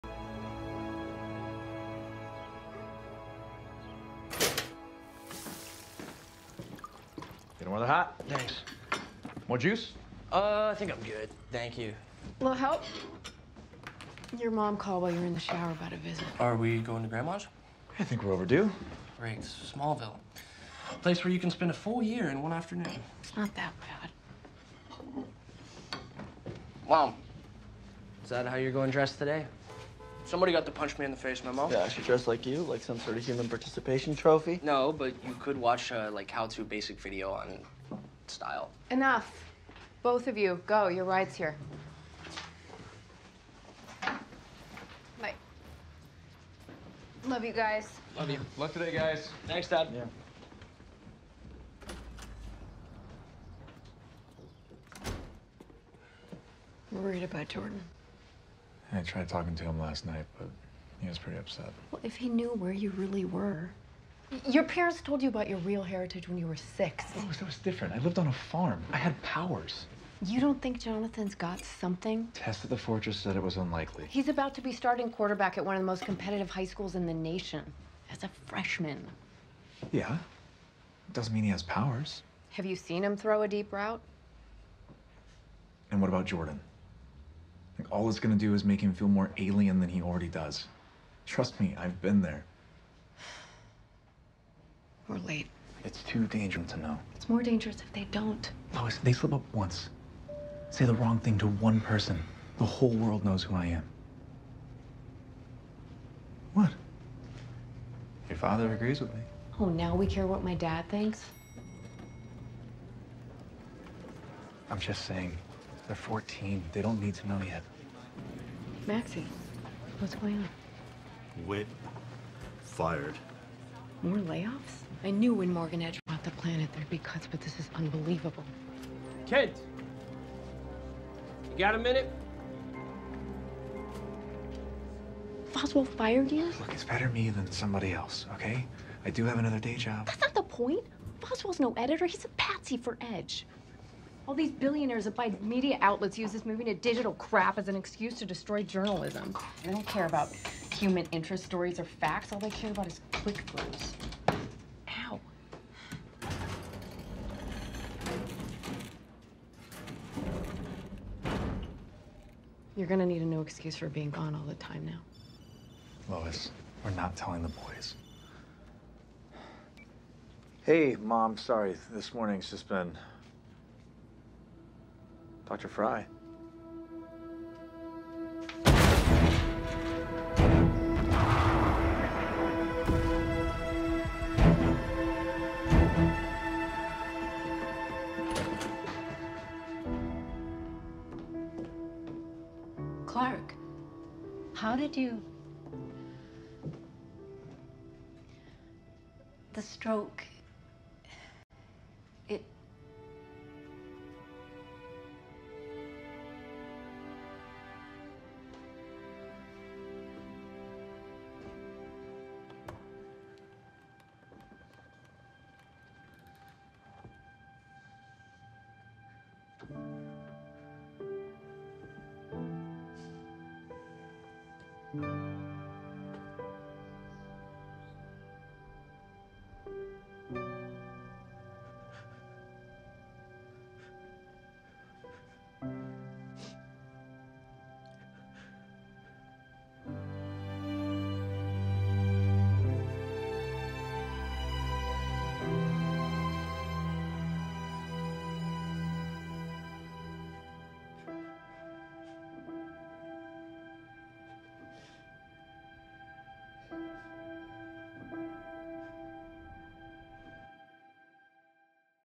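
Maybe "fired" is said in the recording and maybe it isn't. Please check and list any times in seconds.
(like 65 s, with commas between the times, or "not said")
122 s, 135 s.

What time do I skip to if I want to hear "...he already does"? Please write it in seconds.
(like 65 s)
89 s.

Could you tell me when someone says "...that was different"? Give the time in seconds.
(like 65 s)
67 s.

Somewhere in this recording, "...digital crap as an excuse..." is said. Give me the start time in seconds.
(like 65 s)
146 s.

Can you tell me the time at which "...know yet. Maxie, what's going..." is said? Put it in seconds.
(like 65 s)
117 s.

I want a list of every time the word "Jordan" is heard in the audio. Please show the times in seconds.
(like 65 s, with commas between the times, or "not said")
57 s, 86 s.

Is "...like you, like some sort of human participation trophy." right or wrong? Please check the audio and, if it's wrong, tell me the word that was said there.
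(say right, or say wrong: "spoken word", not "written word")
right.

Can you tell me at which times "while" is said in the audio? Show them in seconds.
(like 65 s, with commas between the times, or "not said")
15 s.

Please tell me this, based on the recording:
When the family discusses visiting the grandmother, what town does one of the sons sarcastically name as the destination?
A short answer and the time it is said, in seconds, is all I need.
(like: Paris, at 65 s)
Smallville, at 19 s.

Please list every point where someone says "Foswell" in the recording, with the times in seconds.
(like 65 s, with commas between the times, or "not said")
135 s, 141 s.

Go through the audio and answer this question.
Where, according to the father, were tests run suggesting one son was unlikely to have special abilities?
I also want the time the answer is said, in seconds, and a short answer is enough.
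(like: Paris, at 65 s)
the Fortress, at 72 s.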